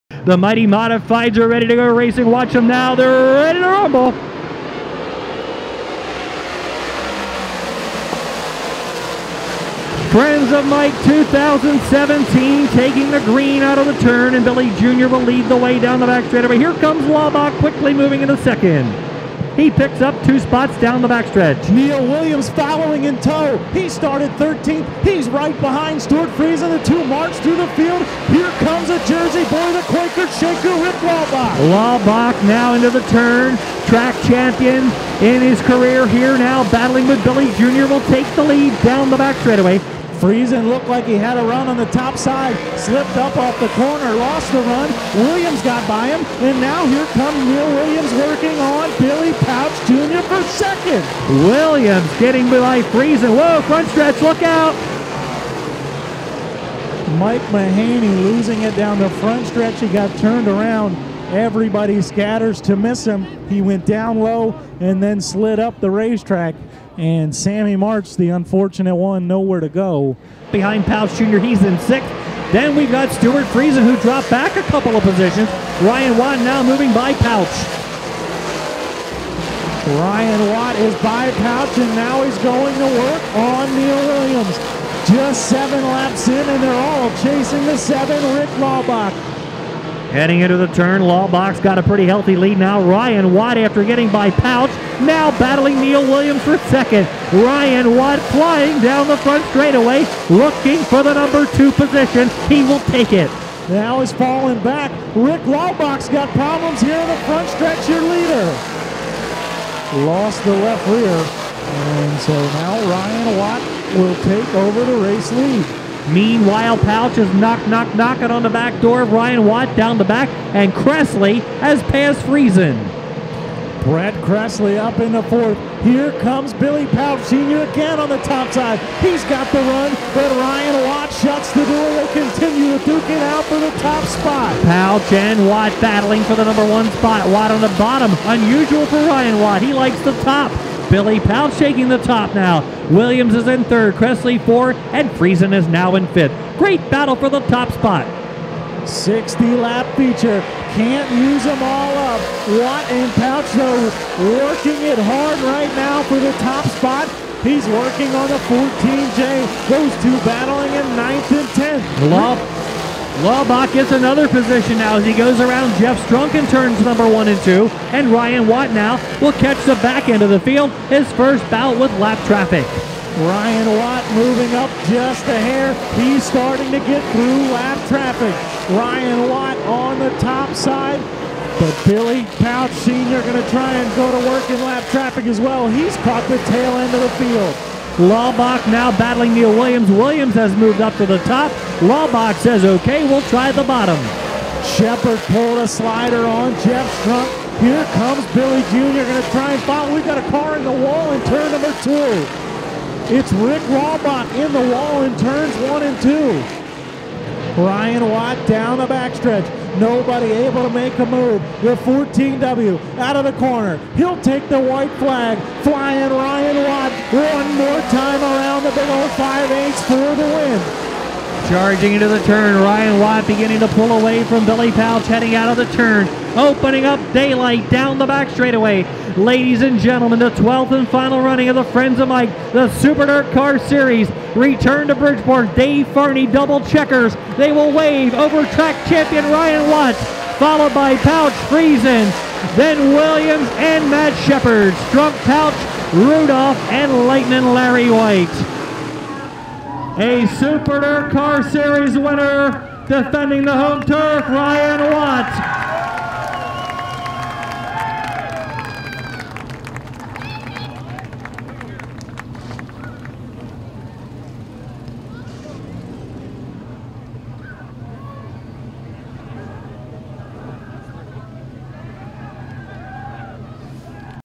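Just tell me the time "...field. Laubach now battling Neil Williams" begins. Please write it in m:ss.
3:07.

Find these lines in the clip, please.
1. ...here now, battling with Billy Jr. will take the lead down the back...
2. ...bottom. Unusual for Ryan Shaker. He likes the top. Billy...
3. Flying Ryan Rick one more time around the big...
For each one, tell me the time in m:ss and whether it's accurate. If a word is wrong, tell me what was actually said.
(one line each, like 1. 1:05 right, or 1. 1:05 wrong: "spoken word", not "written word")
1. 0:36 right
2. 2:17 wrong: "Watt", not "Shaker"
3. 3:35 wrong: "Watt", not "Rick".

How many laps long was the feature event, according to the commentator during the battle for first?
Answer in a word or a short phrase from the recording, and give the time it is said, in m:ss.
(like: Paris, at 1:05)
60, at 2:28.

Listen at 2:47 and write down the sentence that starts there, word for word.
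And Ryan Watt now will catch the back end of the field, his first bout with lap traffic.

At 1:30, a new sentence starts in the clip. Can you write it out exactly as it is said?
Heading into the turn, Laubach's got a pretty healthy lead now.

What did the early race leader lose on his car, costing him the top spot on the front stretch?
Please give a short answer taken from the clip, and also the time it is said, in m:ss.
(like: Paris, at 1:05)
Left rear, at 1:50.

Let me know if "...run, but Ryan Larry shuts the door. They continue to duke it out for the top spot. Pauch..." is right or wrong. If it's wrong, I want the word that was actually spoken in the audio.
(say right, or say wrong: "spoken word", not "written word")
wrong: "Watt", not "Larry".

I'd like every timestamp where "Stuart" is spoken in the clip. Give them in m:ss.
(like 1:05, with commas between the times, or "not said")
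0:26, 1:13.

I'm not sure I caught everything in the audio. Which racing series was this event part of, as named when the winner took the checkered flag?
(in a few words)
Super Dirt Car Series.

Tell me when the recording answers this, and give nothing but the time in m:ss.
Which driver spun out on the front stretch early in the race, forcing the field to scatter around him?
0:57.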